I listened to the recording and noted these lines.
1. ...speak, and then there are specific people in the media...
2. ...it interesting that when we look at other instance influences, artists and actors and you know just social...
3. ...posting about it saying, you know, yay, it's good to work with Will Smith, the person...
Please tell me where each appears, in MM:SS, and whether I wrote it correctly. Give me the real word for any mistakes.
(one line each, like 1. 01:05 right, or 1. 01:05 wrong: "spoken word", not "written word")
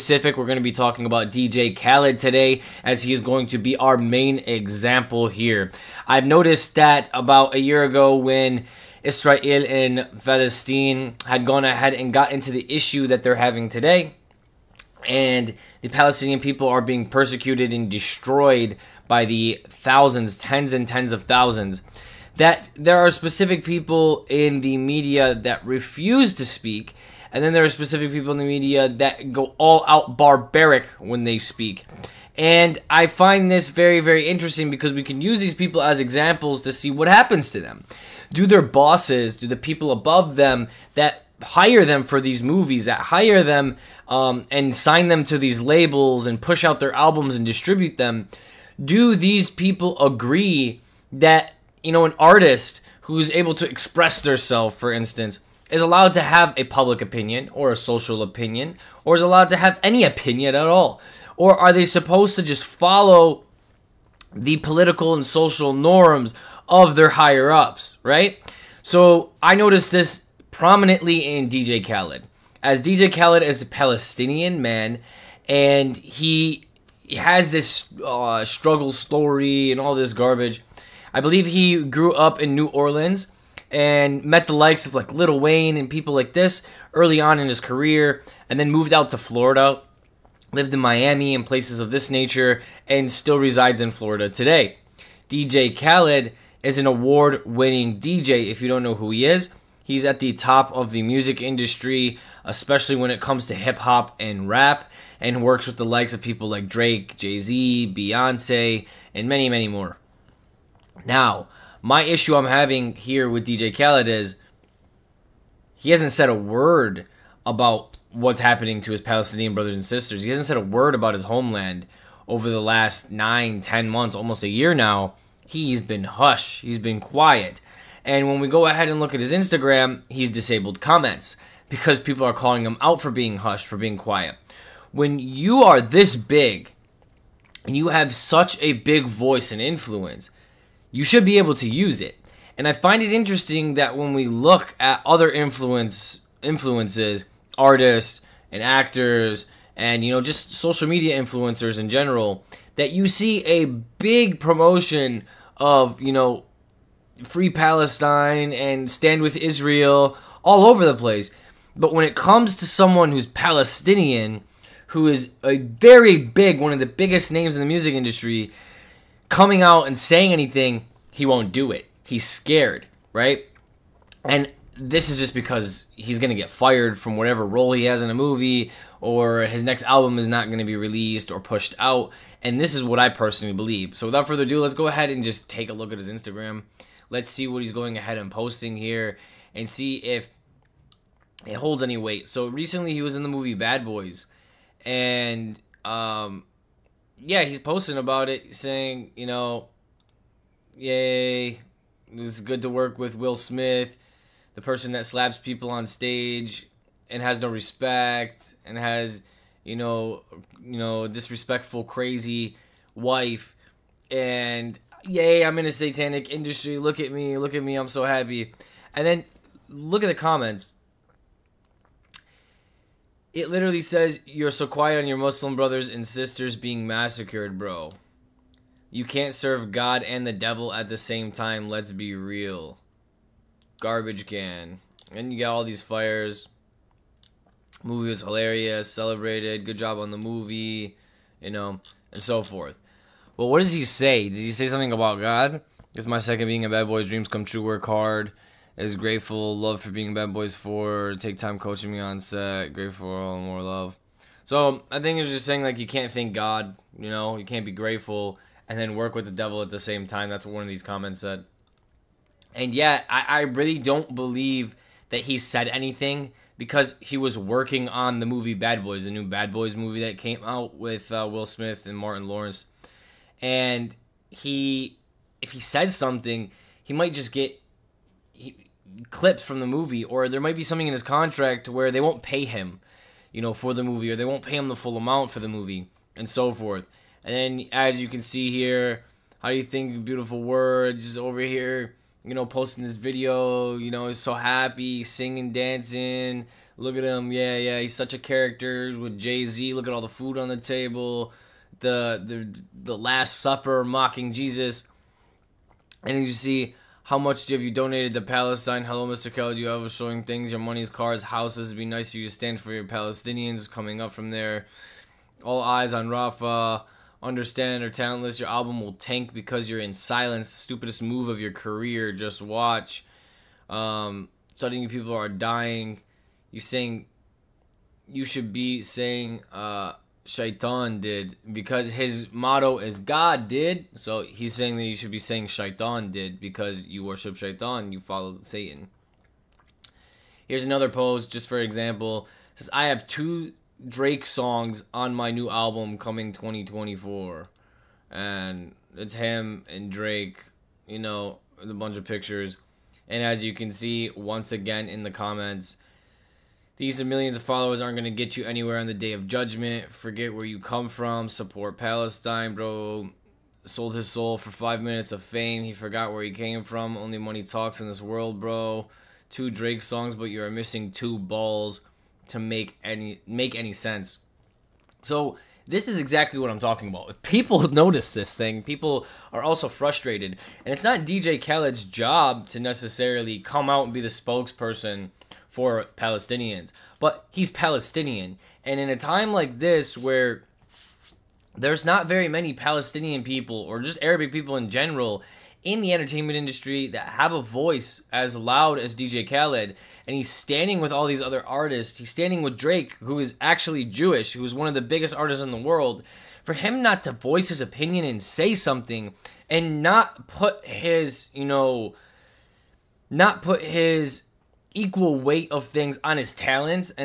1. 00:26 right
2. 02:23 wrong: "influence", not "instance"
3. 03:17 right.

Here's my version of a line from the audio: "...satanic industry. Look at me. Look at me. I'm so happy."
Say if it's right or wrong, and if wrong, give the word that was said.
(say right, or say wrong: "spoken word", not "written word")
right.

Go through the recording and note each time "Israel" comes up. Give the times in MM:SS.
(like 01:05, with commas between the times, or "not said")
00:09, 02:39.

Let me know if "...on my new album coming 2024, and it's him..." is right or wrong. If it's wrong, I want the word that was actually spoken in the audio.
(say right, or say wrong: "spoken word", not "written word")
right.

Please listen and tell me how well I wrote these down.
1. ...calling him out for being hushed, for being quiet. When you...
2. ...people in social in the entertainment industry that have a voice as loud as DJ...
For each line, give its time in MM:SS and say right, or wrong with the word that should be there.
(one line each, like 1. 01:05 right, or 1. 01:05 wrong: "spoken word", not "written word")
1. 02:12 right
2. 06:34 wrong: "general", not "social".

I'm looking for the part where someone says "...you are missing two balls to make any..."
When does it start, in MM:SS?
06:10.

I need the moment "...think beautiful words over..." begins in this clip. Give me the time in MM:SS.
04:49.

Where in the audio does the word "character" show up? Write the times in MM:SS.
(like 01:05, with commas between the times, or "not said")
04:58.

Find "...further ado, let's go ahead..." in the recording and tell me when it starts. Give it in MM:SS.
03:04.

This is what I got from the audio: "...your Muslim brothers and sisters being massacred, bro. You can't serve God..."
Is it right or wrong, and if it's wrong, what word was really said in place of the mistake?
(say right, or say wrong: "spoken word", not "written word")
right.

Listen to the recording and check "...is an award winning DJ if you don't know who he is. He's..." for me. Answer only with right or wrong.
right.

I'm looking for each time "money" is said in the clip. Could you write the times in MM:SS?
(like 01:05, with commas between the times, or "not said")
05:10, 06:07.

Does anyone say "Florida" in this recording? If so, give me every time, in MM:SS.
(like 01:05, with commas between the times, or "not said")
01:29, 01:33.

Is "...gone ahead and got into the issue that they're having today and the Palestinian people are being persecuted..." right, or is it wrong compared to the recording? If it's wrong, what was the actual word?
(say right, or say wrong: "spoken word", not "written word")
right.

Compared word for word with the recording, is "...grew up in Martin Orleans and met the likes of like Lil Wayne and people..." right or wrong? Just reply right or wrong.
wrong.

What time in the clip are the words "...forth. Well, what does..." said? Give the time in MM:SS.
04:02.